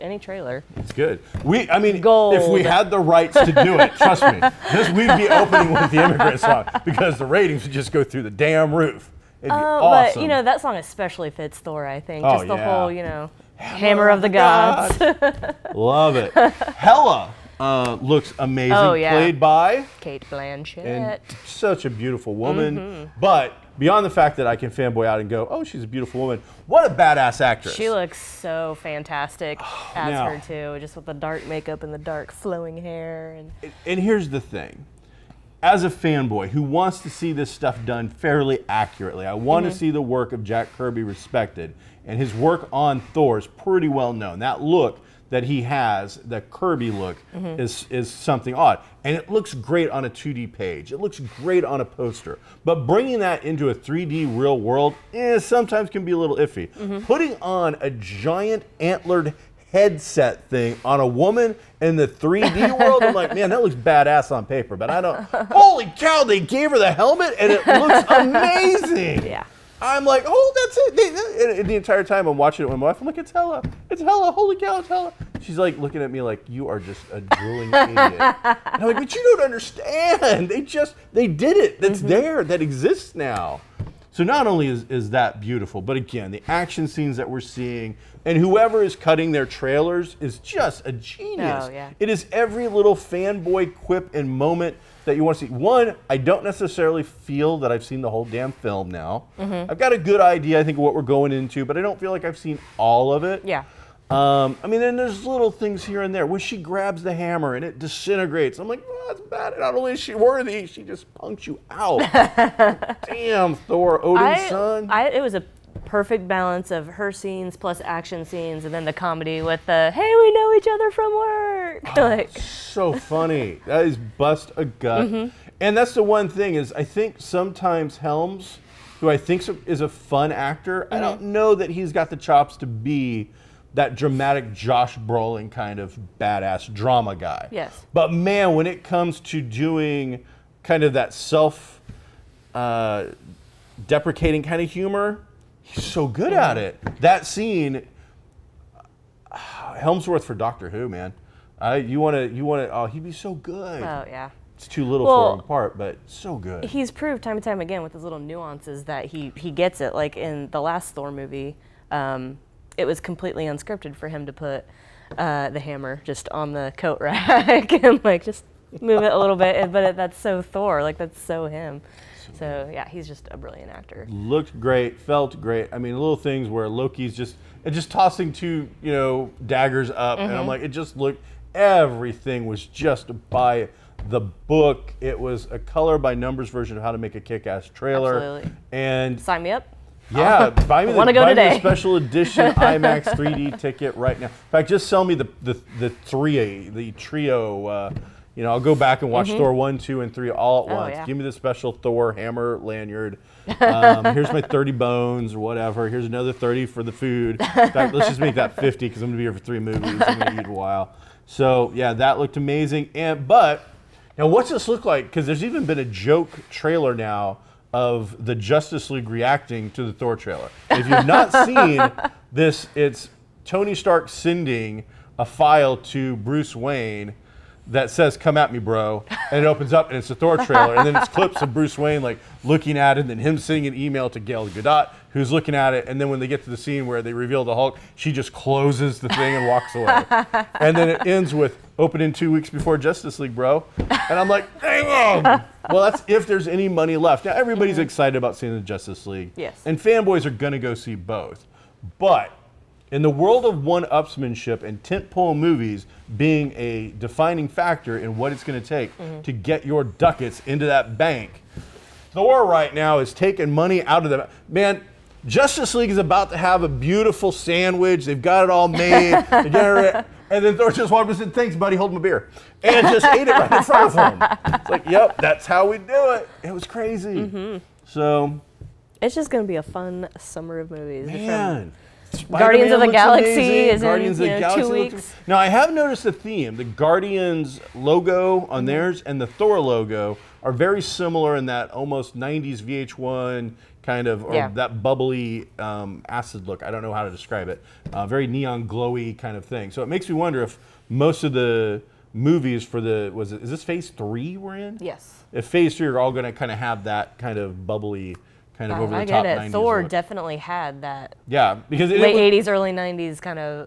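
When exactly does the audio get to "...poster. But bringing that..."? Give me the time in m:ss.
0:51.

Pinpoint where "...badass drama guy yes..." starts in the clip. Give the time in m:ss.
2:16.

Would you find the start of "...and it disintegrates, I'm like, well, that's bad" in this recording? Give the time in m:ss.
1:47.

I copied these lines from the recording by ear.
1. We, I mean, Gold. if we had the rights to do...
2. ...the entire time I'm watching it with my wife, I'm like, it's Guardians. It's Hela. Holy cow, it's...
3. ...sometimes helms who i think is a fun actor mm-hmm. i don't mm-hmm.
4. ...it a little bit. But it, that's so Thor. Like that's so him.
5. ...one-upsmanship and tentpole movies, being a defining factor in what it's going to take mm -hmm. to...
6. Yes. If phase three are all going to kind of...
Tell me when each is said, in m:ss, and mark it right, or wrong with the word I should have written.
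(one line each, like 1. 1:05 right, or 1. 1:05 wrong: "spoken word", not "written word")
1. 0:01 right
2. 1:11 wrong: "Hela", not "Guardians"
3. 2:07 right
4. 2:49 right
5. 4:13 right
6. 5:04 right.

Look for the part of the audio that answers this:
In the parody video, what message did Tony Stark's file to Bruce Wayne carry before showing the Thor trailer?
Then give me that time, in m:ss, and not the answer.
3:48.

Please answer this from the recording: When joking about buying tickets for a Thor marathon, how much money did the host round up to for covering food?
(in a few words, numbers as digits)
50.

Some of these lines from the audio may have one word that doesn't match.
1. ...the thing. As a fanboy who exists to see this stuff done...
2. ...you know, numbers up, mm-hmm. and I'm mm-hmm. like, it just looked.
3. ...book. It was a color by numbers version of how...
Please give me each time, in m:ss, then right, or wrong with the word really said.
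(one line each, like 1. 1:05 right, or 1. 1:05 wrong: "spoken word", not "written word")
1. 0:34 wrong: "wants", not "exists"
2. 2:58 wrong: "daggers", not "numbers"
3. 3:04 right.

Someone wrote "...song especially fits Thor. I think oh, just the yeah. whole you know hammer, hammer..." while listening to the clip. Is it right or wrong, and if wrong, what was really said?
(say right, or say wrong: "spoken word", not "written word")
right.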